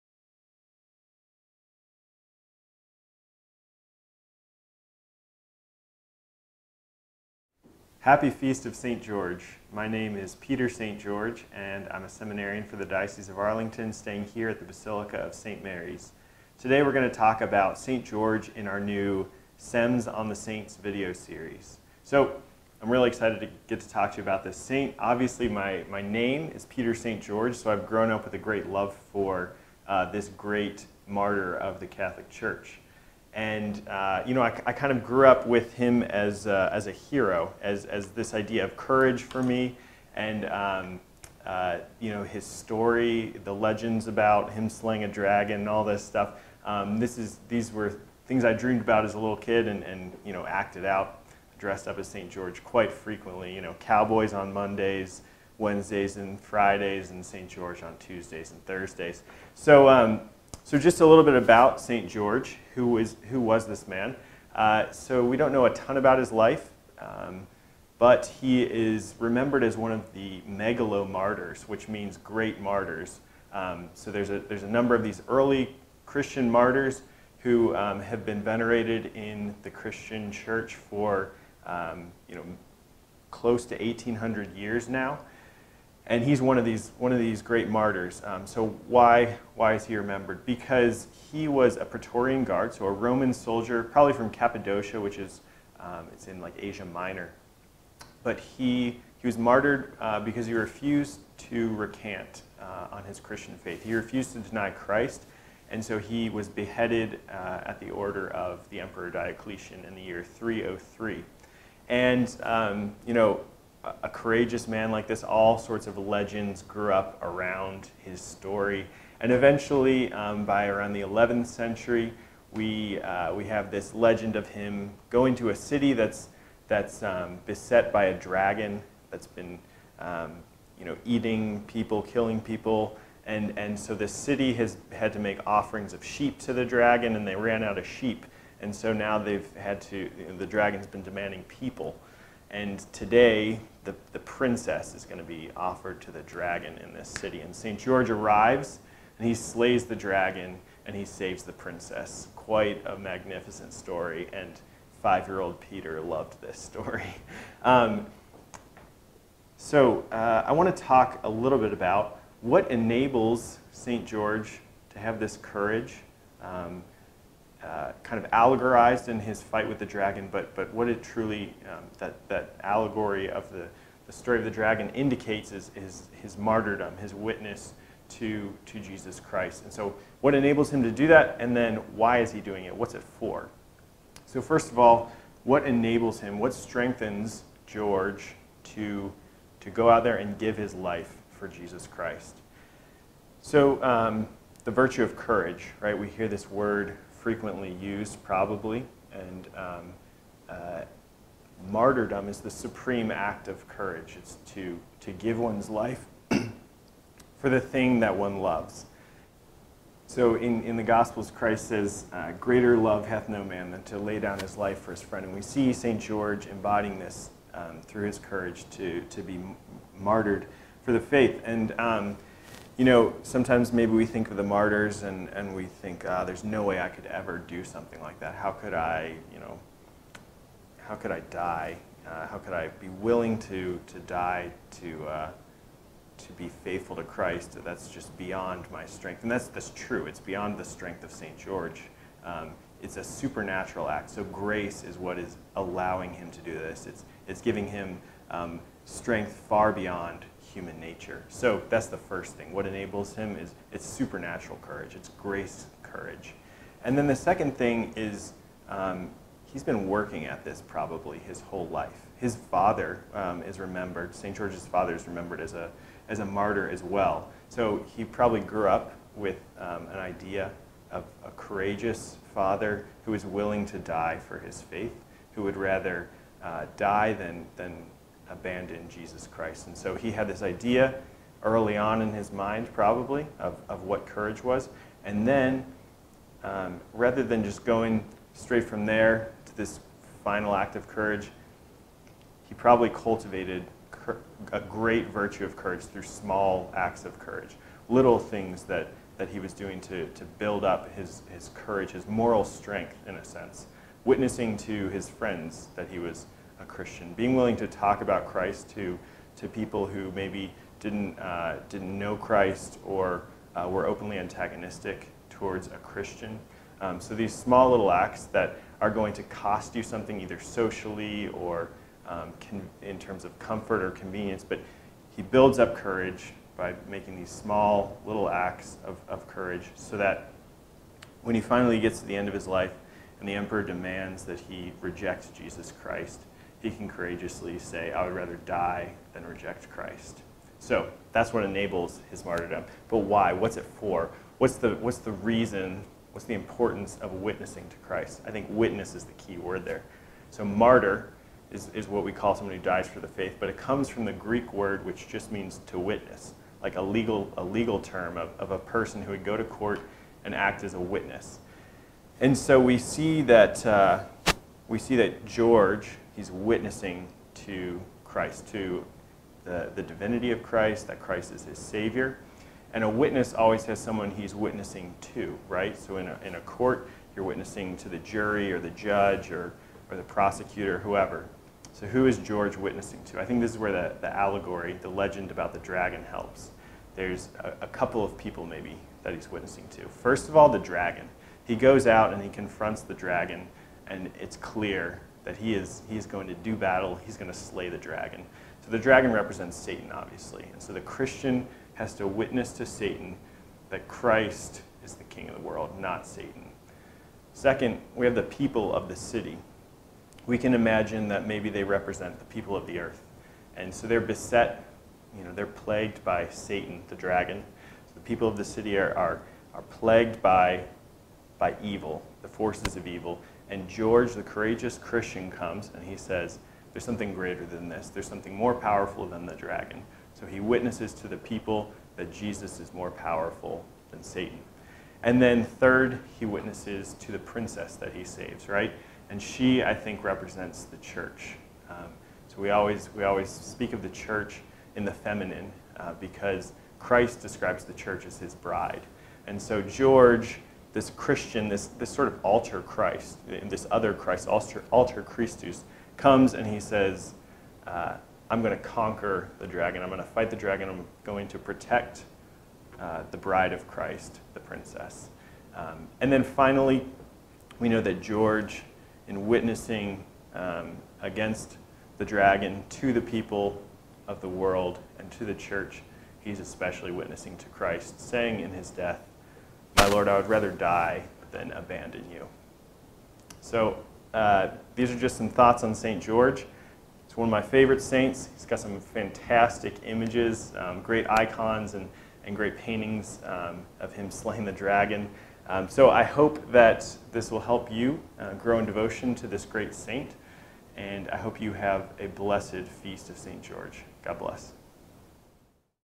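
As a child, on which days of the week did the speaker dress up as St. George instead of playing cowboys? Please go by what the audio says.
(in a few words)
Tuesdays and Thursdays.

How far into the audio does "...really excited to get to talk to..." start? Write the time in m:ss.
0:22.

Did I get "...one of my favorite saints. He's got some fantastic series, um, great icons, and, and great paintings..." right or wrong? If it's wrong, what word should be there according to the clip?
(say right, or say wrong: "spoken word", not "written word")
wrong: "images", not "series".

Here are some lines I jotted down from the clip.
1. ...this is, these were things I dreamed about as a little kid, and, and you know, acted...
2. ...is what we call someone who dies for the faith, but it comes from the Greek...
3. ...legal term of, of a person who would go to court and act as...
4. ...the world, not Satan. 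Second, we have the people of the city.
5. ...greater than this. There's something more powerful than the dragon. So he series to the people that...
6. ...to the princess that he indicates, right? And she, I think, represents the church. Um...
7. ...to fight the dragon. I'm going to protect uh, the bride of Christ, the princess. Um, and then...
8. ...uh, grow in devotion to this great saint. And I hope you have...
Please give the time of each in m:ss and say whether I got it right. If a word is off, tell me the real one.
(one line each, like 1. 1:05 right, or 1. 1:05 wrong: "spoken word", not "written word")
1. 0:46 right
2. 5:51 right
3. 5:57 right
4. 6:45 right
5. 7:07 wrong: "witnesses", not "series"
6. 7:17 wrong: "saves", not "indicates"
7. 7:40 right
8. 8:18 right.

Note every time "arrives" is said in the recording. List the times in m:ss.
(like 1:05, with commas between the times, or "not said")
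2:28.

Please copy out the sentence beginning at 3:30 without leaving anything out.
So in, in the Gospels, Christ says, uh, greater love hath no man than to lay down his life for his friend.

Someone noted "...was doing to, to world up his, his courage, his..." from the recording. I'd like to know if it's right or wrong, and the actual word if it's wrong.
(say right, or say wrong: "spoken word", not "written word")
wrong: "build", not "world".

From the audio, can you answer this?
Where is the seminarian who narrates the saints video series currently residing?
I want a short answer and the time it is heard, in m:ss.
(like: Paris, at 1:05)
Basilica of St. Mary's, at 0:14.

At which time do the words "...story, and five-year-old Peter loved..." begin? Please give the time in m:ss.
2:33.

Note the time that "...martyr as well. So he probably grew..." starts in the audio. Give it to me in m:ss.
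4:26.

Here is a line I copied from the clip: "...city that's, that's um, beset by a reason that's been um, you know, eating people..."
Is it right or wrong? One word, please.
wrong.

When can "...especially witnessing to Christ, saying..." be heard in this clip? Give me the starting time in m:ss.
7:56.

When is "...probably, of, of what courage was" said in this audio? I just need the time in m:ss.
4:42.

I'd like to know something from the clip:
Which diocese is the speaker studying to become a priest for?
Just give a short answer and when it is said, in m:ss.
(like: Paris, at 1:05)
Arlington, at 0:12.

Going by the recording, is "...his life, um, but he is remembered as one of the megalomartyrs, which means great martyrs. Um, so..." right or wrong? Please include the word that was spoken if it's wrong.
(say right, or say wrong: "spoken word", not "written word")
right.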